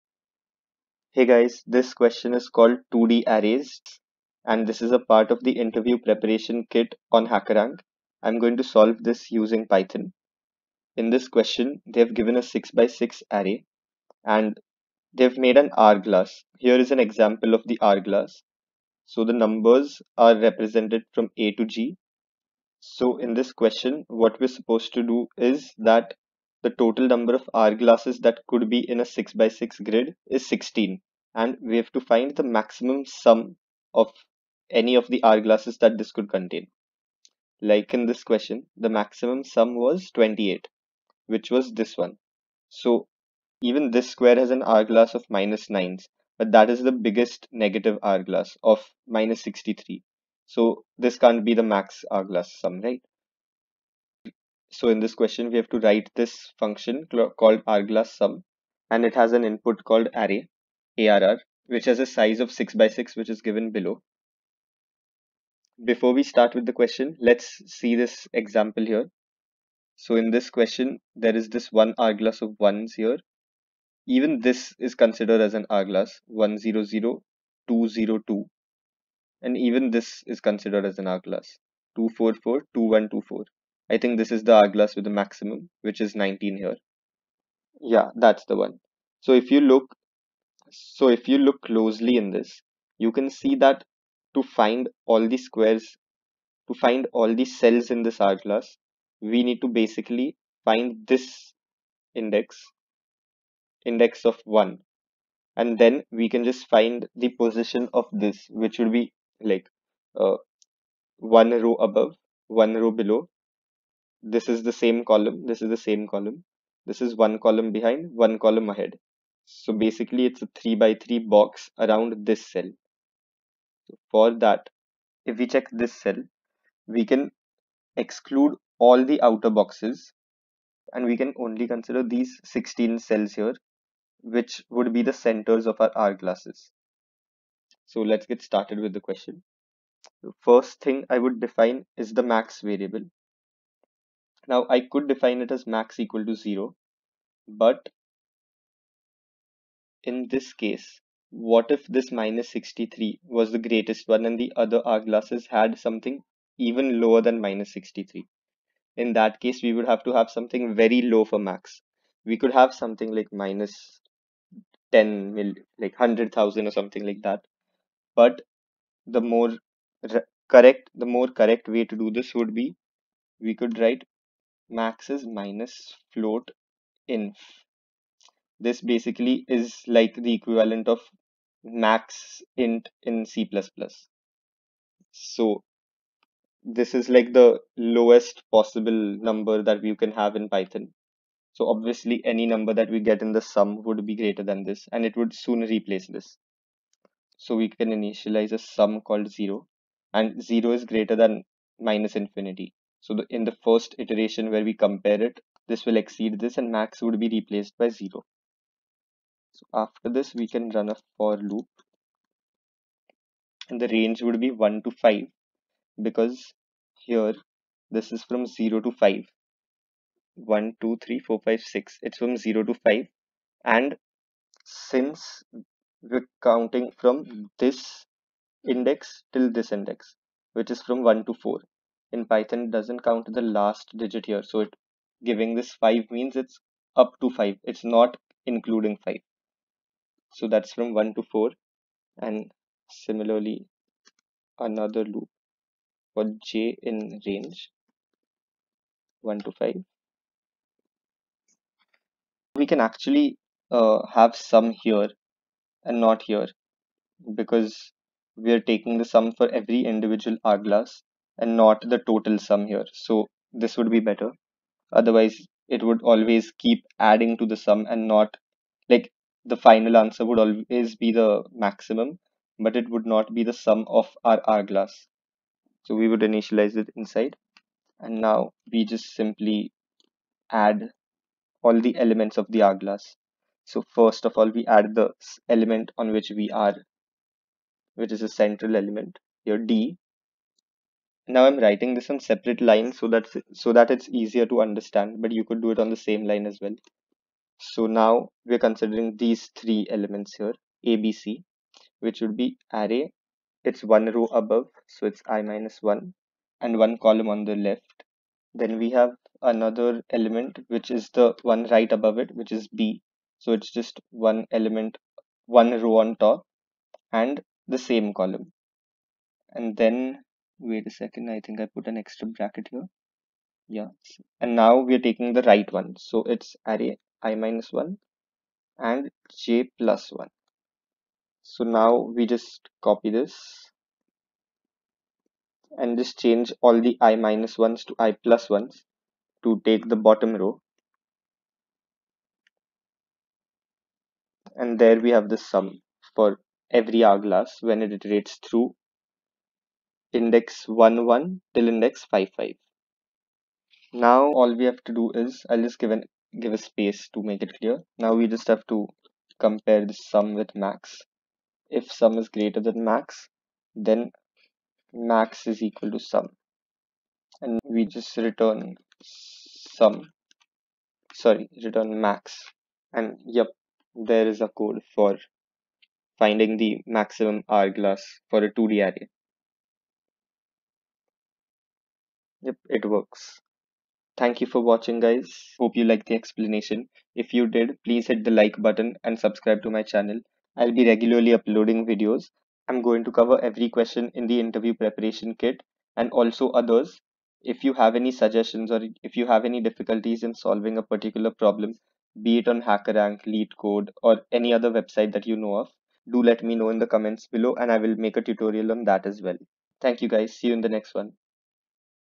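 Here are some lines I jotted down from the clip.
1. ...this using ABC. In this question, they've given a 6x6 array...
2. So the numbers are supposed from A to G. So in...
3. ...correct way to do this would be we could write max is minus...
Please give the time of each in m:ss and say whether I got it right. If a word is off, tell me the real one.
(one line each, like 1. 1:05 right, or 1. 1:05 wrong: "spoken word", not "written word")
1. 0:09 wrong: "Python", not "ABC"
2. 0:19 wrong: "represented", not "supposed"
3. 2:51 right.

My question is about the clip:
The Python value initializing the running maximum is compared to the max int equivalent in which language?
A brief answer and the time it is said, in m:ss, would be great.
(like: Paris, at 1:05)
C++, at 3:03.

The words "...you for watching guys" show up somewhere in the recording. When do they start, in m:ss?
6:24.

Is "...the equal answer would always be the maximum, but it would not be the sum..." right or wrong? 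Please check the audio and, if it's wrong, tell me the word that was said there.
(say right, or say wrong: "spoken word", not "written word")
wrong: "final", not "equal".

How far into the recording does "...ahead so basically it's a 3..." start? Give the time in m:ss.
1:58.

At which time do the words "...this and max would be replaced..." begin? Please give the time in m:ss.
3:26.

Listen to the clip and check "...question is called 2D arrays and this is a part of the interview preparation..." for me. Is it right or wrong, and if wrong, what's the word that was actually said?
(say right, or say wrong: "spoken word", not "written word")
right.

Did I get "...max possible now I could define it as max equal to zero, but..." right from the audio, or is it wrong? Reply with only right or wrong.
wrong.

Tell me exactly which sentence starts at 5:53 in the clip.
Now all we have to do is I'll just give an give a space to make it clear.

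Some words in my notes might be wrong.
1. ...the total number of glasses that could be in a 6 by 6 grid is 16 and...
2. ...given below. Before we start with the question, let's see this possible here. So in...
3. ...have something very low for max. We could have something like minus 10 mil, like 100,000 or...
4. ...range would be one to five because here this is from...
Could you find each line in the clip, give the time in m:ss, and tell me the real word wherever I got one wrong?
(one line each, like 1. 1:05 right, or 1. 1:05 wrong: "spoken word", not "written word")
1. 0:26 right
2. 1:03 wrong: "example", not "possible"
3. 2:40 right
4. 3:33 right.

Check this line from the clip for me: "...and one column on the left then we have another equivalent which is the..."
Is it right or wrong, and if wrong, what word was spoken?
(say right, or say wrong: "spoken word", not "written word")
wrong: "element", not "equivalent".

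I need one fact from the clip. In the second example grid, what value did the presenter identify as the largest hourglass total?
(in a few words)
19.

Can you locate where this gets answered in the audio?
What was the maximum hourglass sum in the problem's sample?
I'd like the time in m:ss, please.
0:40.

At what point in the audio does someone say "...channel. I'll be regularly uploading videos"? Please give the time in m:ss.
6:29.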